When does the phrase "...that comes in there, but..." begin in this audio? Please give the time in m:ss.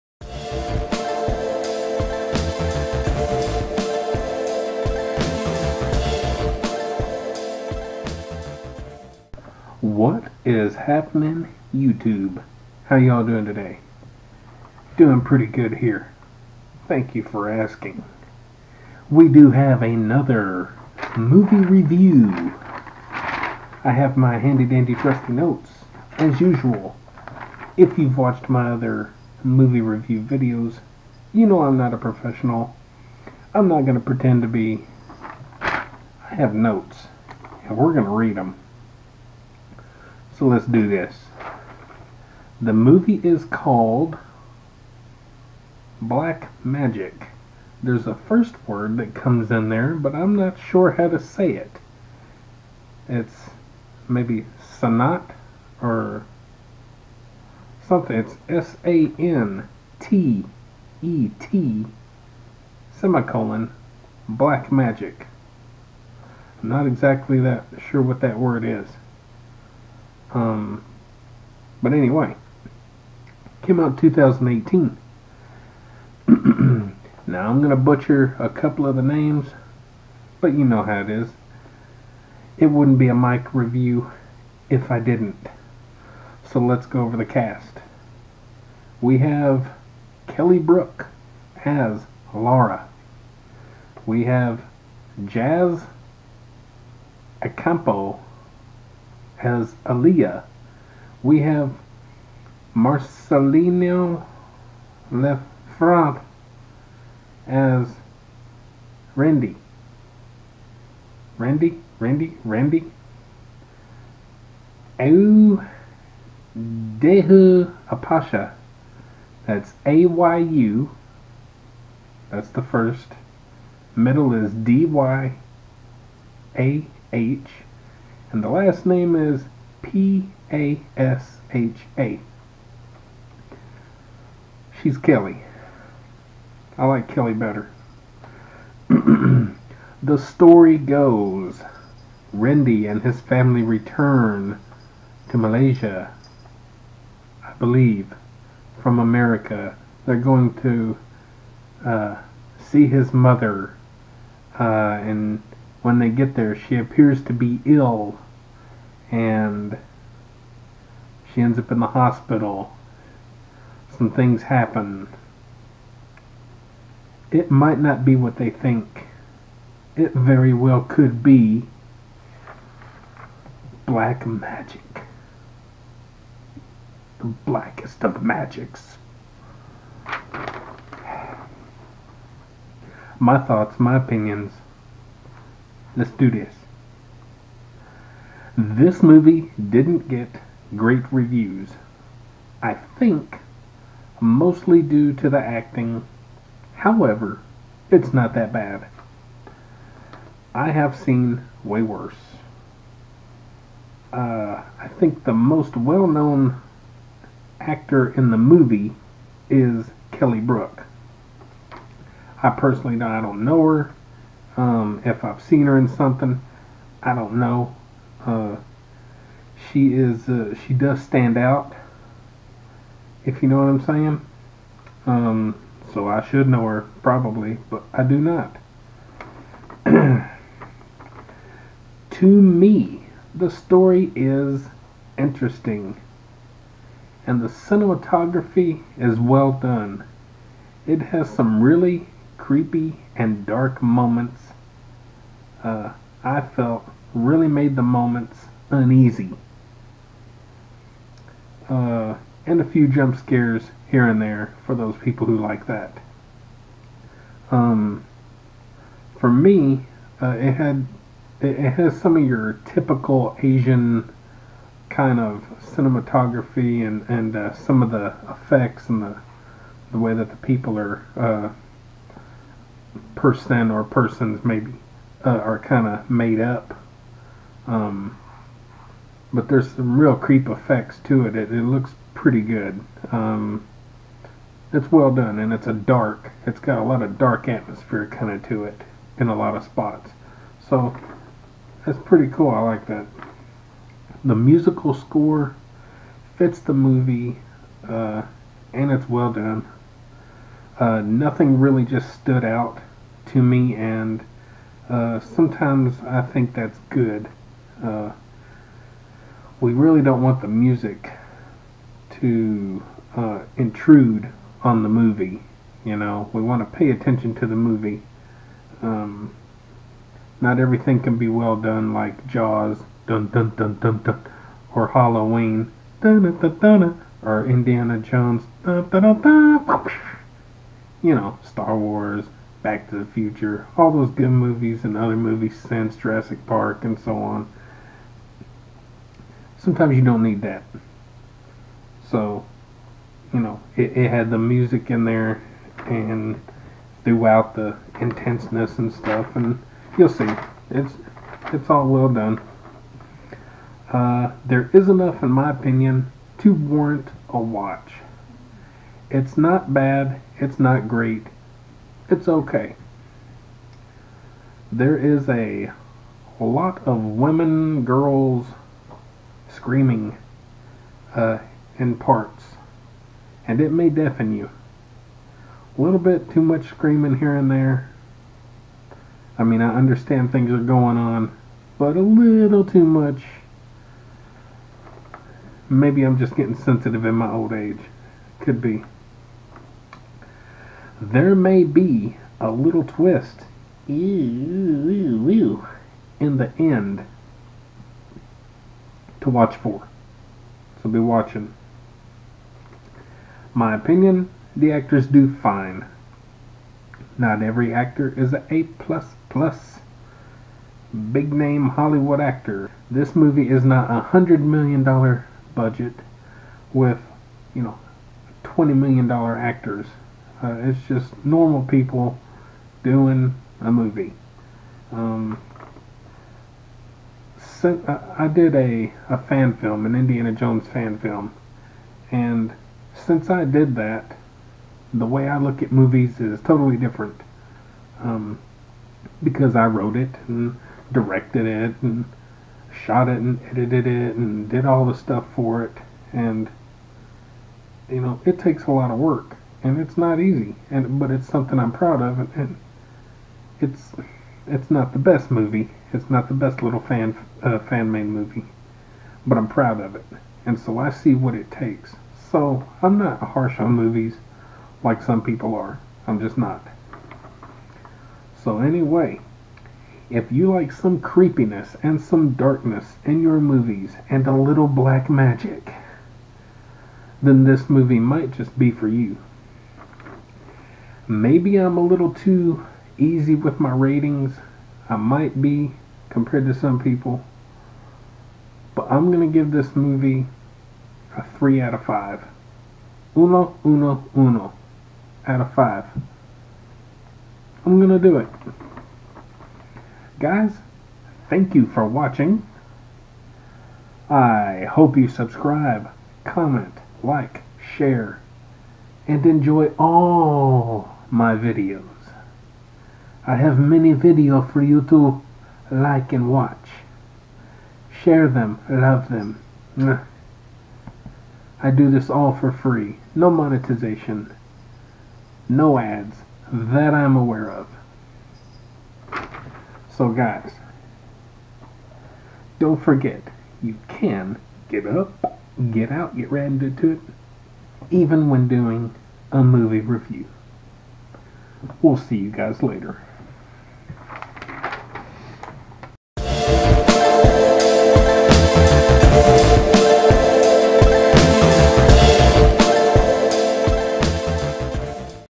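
0:48.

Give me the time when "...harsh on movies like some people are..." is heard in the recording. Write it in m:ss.
7:43.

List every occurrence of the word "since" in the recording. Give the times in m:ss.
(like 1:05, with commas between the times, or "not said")
5:35, 7:12.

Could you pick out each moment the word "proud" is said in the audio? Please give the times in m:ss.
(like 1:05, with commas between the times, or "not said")
7:31, 7:39.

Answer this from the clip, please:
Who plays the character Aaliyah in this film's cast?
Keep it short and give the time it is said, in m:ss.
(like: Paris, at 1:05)
Jazz Acampo, at 1:35.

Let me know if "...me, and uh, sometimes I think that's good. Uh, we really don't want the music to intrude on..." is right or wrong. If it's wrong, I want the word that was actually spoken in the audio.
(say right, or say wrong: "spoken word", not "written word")
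right.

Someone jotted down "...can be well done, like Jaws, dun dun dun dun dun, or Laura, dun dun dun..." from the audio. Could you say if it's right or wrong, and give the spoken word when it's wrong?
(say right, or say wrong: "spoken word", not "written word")
wrong: "Halloween", not "Laura".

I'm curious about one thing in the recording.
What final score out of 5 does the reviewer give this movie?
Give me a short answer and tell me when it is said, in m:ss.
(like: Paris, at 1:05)
3, at 8:11.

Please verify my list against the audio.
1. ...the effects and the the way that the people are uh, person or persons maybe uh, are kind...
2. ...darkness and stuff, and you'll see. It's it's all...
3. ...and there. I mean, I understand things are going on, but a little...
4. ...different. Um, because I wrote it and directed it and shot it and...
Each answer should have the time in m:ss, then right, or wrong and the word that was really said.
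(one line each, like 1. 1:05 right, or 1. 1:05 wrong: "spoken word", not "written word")
1. 4:27 right
2. 5:47 wrong: "intenseness", not "darkness"
3. 6:17 right
4. 7:16 right.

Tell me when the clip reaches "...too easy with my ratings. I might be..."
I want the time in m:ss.
8:02.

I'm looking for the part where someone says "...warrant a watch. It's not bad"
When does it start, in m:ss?
5:56.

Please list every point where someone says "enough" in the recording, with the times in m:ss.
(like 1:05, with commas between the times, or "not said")
5:54.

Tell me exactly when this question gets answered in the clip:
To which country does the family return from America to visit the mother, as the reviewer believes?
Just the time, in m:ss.
2:25.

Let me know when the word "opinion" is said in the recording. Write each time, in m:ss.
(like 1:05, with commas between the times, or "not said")
3:03, 5:55, 6:43.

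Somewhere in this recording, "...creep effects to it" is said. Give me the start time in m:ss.
4:40.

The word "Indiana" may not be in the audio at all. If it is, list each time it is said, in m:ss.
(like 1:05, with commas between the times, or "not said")
5:27, 7:09.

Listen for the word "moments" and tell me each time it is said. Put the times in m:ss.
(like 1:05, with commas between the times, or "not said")
4:03, 4:07.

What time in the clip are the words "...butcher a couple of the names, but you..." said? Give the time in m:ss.
1:17.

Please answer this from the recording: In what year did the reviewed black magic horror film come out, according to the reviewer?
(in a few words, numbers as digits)
2018.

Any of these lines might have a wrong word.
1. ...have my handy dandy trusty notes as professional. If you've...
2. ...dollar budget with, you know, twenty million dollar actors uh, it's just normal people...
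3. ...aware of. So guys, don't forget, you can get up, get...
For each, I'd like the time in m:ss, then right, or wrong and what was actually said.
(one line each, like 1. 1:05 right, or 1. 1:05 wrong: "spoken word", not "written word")
1. 0:23 wrong: "usual", not "professional"
2. 6:54 right
3. 8:47 right.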